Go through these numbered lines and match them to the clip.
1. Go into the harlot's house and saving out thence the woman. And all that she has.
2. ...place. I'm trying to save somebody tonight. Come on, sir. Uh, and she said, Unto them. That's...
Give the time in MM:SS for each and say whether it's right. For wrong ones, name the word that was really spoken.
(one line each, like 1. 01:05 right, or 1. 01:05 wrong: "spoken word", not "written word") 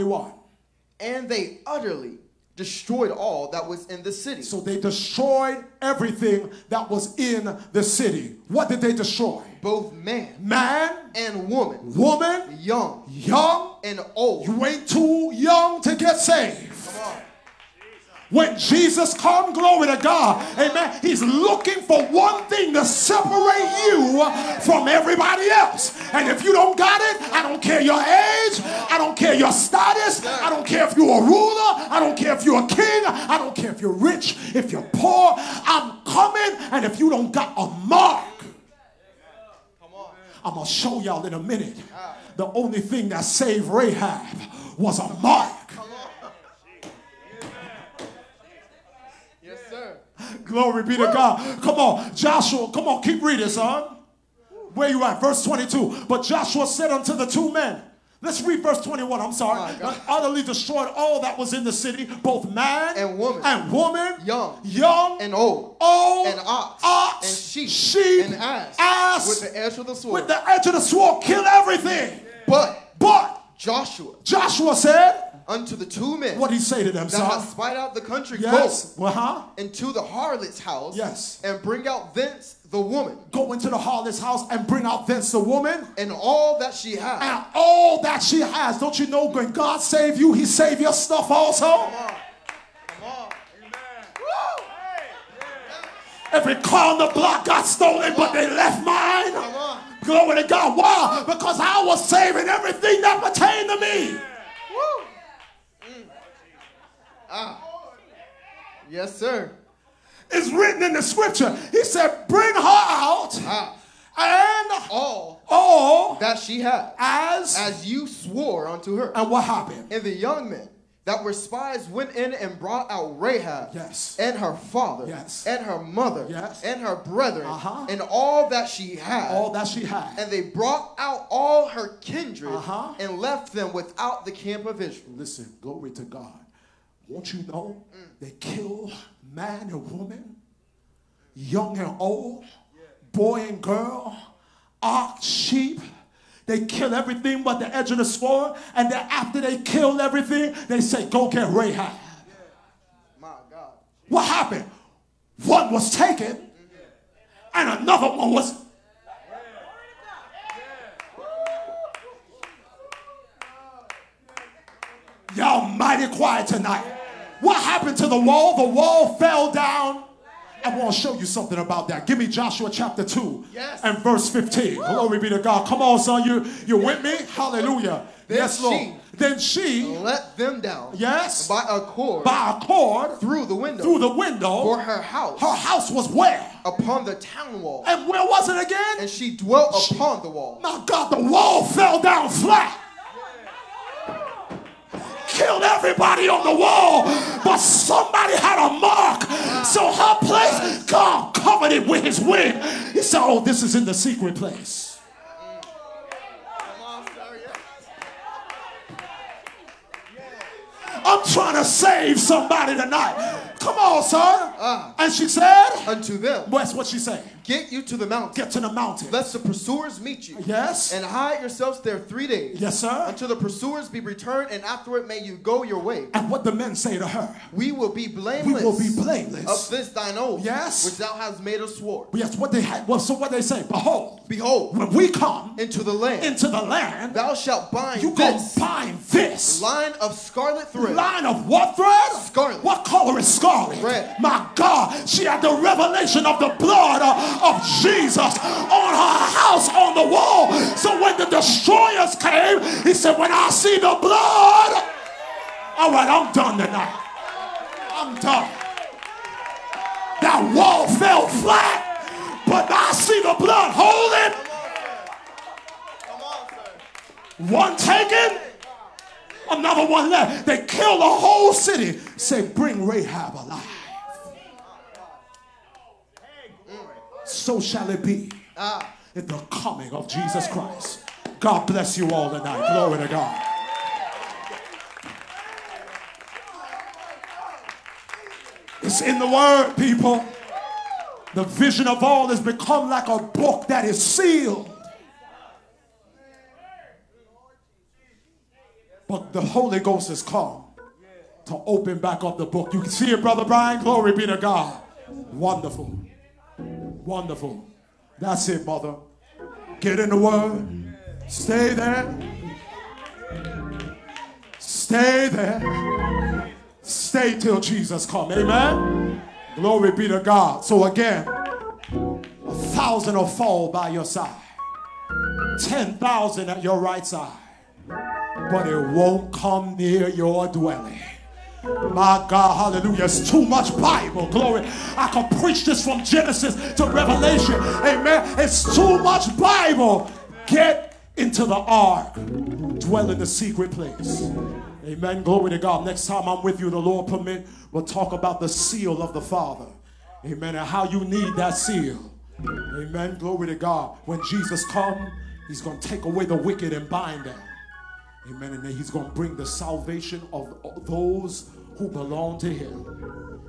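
1. 01:23 wrong: "bring", not "saving"
2. 03:24 right.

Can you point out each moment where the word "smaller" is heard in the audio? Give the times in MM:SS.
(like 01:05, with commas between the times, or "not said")
not said.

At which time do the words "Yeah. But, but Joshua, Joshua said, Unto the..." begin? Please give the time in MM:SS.
01:12.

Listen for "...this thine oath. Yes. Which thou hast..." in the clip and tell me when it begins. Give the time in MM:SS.
03:49.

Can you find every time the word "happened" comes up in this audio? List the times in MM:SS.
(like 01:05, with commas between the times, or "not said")
01:59, 02:34, 02:47.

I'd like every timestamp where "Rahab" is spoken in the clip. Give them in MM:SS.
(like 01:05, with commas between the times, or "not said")
00:43, 02:03, 02:31, 04:32.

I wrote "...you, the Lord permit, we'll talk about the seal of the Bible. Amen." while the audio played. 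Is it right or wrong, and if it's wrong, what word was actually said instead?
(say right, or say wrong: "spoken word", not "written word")
wrong: "Father", not "Bible".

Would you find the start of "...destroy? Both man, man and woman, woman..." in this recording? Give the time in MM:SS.
00:08.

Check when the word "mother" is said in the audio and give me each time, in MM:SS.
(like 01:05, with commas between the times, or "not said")
02:05, 05:08.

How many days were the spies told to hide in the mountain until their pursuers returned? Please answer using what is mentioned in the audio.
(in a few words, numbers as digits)
3.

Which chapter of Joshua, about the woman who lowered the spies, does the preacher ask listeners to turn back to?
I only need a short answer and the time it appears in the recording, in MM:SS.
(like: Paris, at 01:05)
Joshua chapter 2, at 02:52.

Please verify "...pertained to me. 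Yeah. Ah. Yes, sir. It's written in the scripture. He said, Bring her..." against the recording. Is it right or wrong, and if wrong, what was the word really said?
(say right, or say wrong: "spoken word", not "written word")
right.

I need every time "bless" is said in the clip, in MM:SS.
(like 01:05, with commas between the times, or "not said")
04:41.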